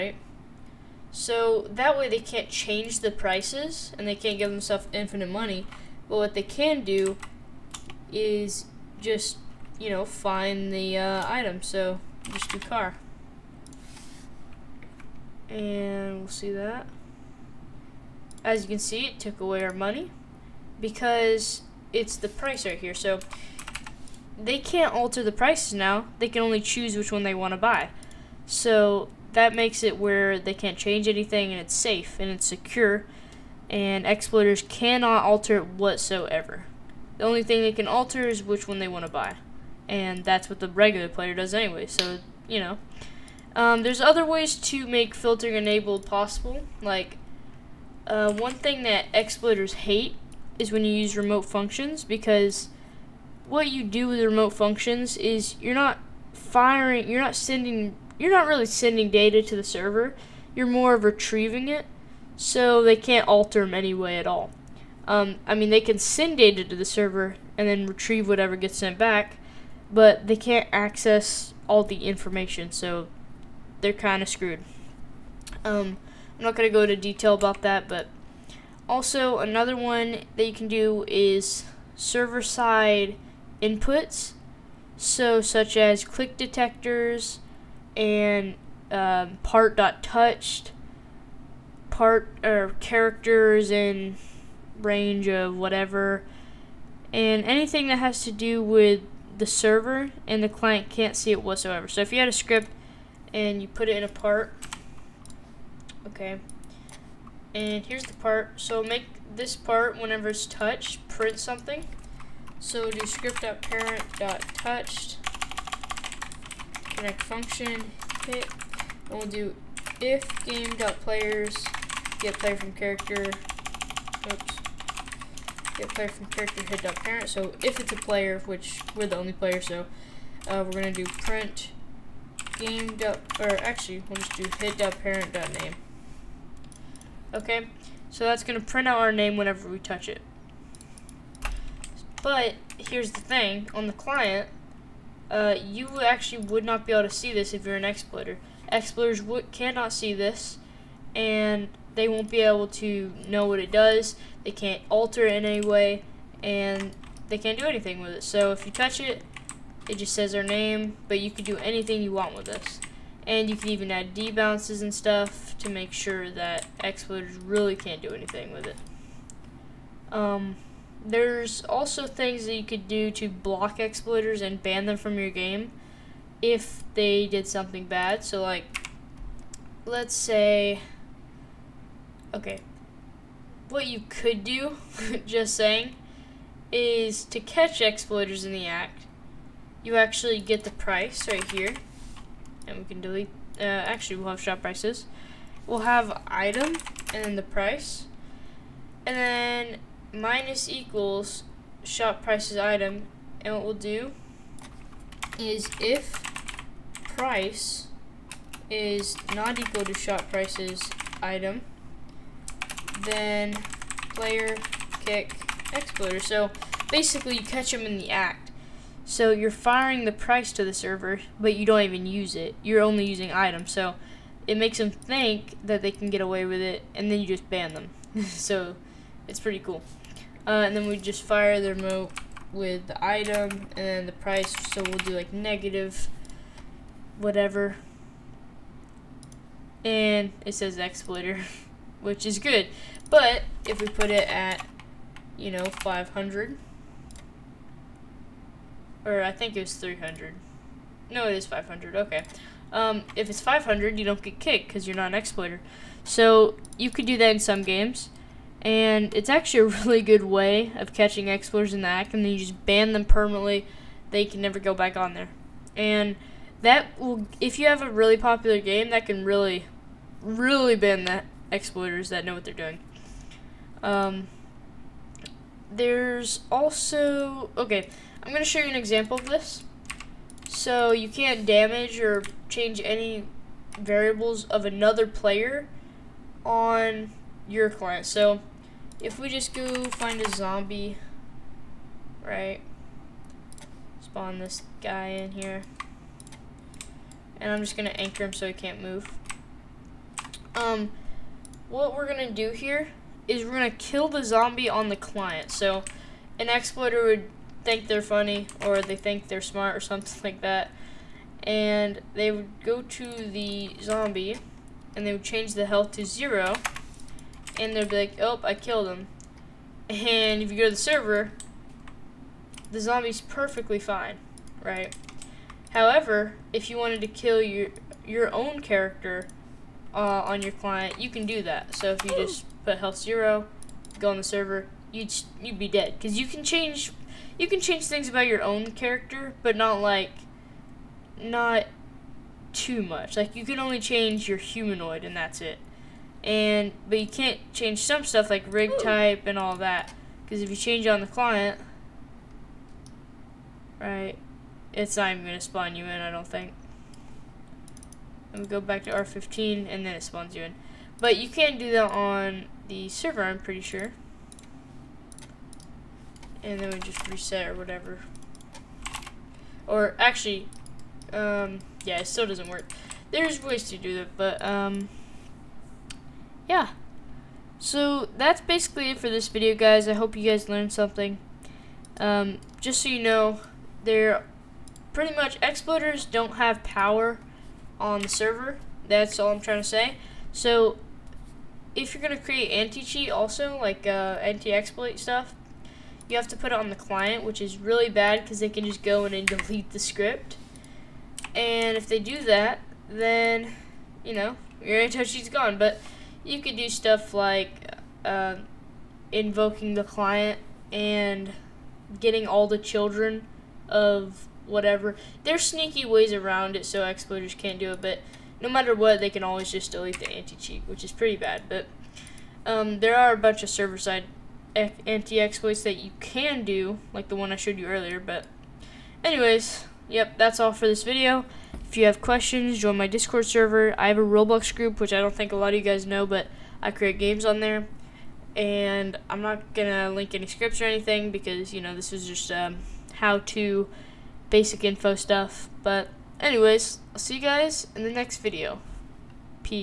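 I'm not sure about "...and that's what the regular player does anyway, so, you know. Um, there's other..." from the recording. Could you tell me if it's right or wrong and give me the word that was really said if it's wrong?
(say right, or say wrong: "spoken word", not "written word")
right.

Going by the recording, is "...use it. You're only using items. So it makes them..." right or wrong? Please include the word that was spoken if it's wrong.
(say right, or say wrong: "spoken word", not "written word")
right.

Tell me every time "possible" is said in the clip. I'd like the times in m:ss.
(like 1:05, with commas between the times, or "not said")
0:46.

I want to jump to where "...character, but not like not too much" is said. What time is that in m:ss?
5:38.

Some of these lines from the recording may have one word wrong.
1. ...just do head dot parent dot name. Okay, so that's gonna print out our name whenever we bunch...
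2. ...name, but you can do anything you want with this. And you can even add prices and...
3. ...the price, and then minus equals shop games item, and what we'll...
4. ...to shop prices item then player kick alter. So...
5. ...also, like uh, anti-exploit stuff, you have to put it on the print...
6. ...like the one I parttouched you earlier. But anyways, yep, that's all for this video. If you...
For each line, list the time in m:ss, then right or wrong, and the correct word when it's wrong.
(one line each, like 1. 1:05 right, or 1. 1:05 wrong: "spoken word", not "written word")
1. 2:14 wrong: "touch", not "bunch"
2. 2:40 wrong: "debounces", not "prices"
3. 3:17 wrong: "prices", not "games"
4. 3:29 wrong: "exploiter", not "alter"
5. 6:33 wrong: "client", not "print"
6. 7:06 wrong: "showed", not "parttouched".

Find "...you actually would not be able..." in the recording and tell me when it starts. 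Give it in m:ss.
2:25.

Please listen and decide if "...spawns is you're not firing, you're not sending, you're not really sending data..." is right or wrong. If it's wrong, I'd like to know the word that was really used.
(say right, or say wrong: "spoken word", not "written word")
wrong: "functions", not "spawns".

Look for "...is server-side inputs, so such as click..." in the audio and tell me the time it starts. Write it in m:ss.
1:21.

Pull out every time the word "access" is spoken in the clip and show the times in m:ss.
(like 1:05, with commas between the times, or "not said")
1:10.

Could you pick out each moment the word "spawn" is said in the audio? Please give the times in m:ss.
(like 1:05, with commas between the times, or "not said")
4:54, 5:55, 6:00.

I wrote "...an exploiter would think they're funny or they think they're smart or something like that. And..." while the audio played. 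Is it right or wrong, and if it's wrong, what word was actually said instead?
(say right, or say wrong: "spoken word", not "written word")
right.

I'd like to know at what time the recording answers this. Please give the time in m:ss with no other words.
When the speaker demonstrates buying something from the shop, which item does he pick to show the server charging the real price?
0:12.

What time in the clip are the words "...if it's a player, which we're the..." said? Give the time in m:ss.
2:07.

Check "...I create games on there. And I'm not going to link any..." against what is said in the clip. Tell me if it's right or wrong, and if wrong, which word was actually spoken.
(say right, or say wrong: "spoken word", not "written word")
right.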